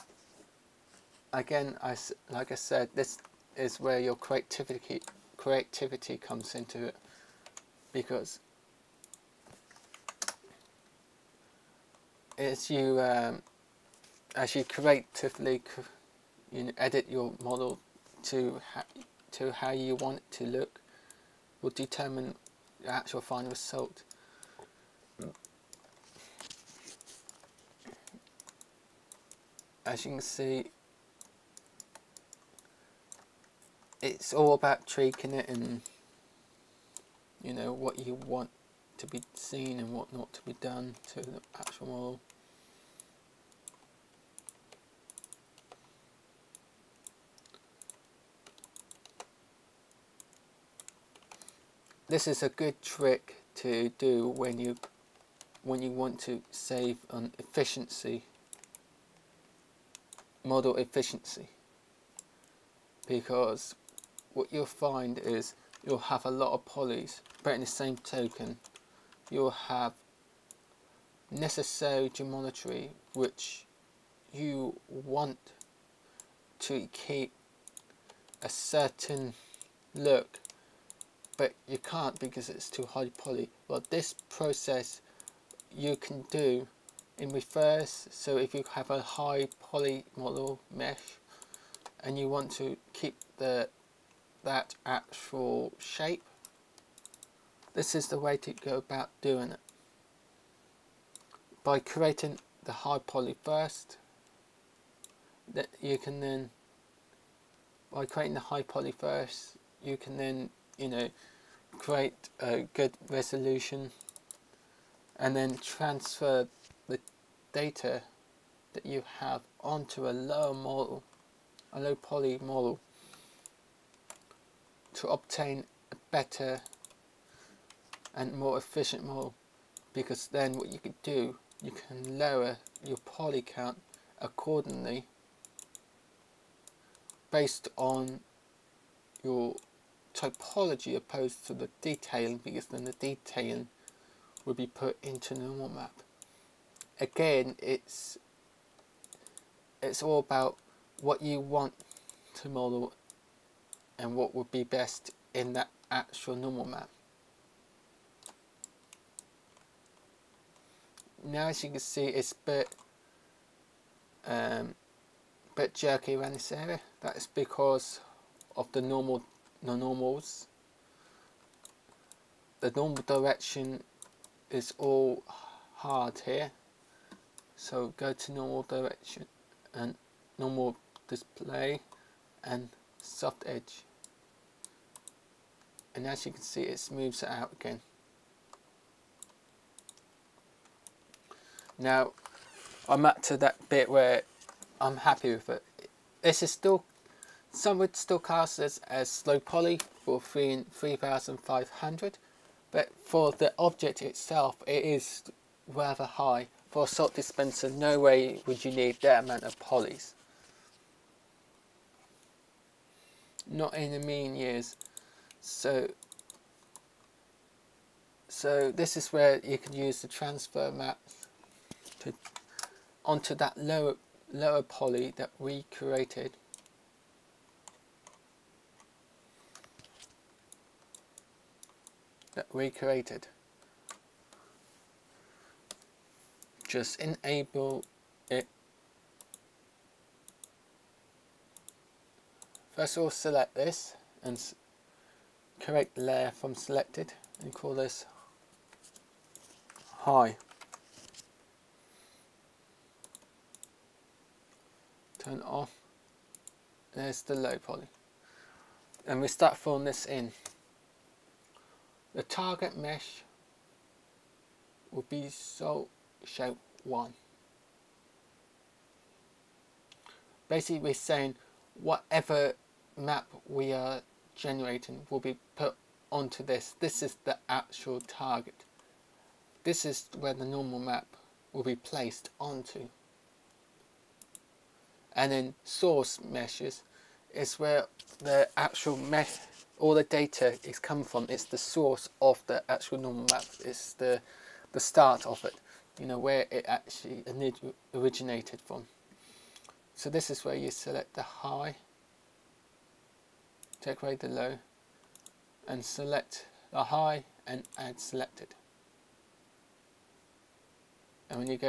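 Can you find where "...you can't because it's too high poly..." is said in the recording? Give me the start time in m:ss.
1:21.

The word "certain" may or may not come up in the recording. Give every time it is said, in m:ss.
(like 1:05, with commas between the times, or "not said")
1:18.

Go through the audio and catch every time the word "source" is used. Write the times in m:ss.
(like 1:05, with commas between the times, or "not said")
4:45, 4:51.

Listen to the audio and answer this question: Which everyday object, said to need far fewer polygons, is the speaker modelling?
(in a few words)
Salt dispenser.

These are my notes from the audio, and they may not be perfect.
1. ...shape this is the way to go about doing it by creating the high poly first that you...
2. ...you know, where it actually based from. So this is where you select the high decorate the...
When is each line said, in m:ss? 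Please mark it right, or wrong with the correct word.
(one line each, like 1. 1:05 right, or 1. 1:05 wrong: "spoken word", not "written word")
1. 1:35 right
2. 4:55 wrong: "originated", not "based".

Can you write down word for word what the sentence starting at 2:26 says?
Again it's it's all about what you want to model and what would be best in that actual normal map.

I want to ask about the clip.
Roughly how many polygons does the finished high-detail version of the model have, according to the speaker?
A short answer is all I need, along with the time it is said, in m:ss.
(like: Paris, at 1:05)
3500, at 3:20.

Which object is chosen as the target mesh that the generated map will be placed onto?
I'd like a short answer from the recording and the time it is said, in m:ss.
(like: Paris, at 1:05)
shape 1, at 4:26.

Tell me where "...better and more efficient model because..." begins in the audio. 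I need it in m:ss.
2:06.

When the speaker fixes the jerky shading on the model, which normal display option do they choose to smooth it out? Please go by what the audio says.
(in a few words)
Soft edge.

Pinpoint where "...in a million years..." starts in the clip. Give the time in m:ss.
3:33.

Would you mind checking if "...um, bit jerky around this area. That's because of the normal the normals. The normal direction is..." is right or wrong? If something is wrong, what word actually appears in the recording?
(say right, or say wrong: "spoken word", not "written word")
right.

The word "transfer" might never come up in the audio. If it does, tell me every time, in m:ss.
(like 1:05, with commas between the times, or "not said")
1:55, 3:40.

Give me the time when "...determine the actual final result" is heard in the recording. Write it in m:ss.
0:21.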